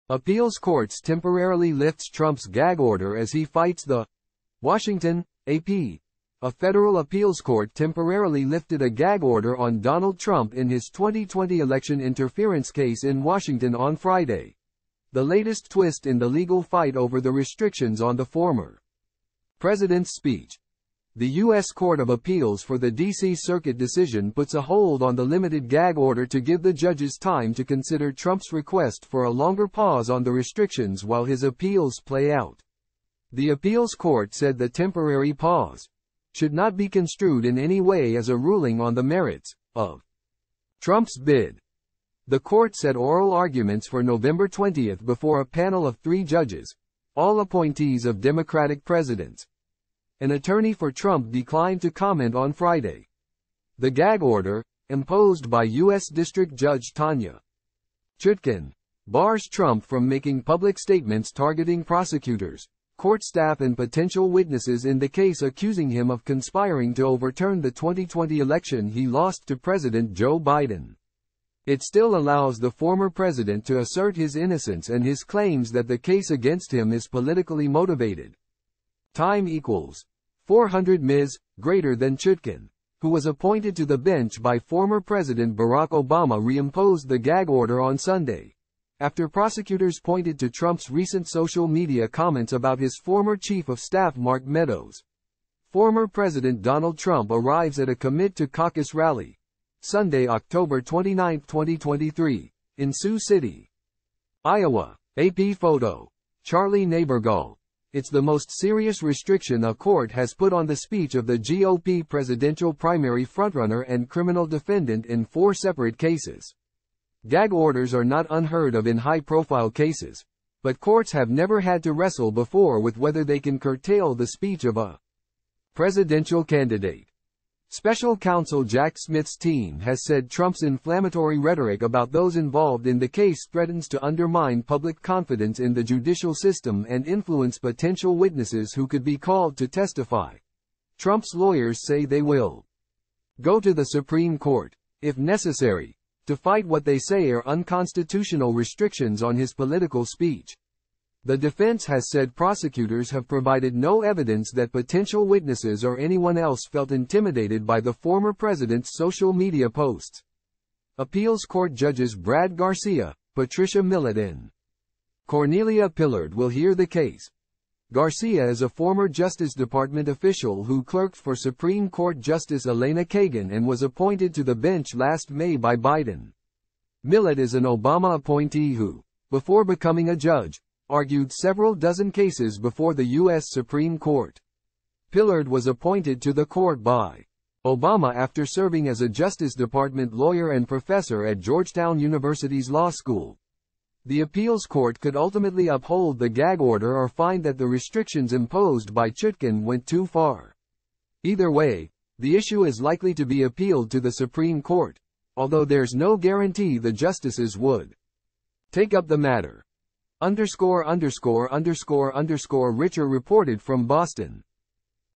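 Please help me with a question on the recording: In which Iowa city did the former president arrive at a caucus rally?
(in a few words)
Sioux City.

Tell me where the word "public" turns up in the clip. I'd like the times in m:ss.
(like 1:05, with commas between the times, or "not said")
1:00, 2:14.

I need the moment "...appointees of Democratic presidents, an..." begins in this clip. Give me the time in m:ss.
0:47.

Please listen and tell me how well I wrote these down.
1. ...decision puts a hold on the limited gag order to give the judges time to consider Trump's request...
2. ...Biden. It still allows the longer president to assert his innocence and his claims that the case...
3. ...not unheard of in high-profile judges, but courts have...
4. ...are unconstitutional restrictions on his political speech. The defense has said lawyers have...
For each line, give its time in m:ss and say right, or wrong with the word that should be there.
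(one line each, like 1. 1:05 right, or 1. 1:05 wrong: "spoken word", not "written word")
1. 0:23 right
2. 1:10 wrong: "former", not "longer"
3. 1:58 wrong: "cases", not "judges"
4. 2:27 wrong: "prosecutors", not "lawyers".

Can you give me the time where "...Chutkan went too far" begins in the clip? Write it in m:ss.
3:19.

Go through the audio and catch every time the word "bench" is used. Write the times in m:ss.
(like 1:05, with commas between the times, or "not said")
1:23, 2:54.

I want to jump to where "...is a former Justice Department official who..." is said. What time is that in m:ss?
2:48.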